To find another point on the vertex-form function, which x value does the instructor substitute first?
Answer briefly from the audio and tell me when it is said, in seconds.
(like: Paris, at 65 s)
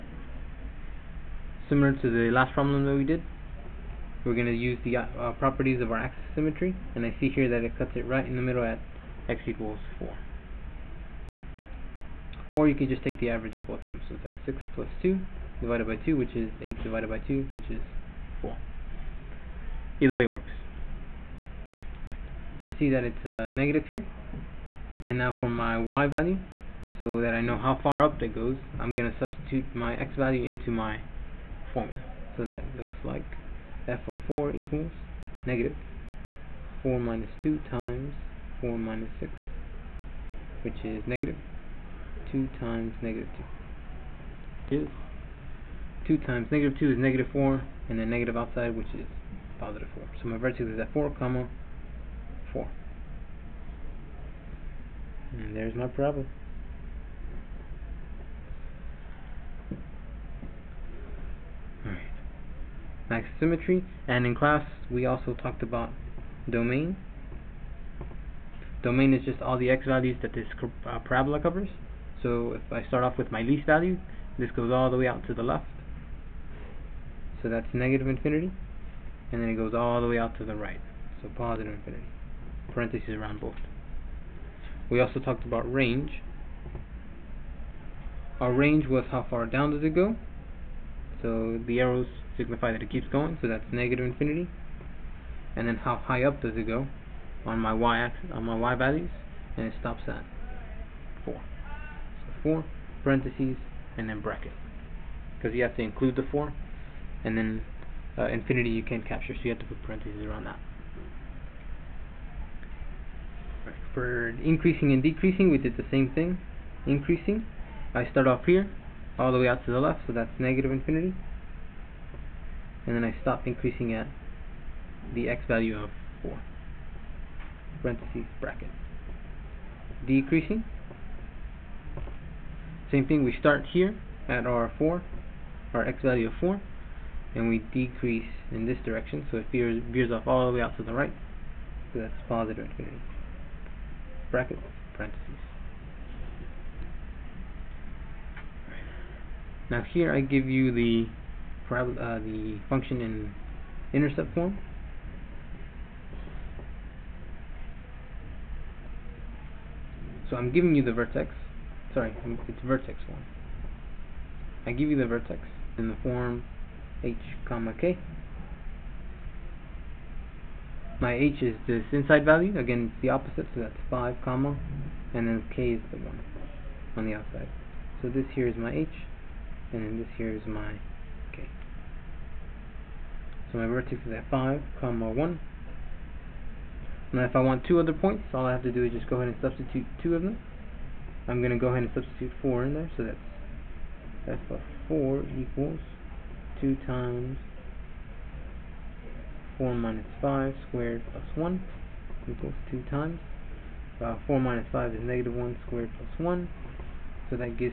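4, at 191 s.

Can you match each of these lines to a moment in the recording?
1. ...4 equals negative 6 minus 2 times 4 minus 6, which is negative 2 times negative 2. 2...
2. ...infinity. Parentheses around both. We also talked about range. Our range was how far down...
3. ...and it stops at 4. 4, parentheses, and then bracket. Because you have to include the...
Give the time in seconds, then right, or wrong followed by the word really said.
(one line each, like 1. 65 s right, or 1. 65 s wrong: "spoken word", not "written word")
1. 34 s wrong: "4", not "6"
2. 81 s right
3. 99 s right.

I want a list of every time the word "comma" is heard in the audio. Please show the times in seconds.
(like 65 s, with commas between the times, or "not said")
51 s, 167 s, 174 s, 184 s.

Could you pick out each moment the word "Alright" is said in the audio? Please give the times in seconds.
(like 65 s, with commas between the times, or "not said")
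61 s.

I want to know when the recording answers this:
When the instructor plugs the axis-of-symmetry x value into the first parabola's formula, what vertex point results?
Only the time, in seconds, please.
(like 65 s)
50 s.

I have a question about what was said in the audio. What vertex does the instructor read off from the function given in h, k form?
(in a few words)
5, 1.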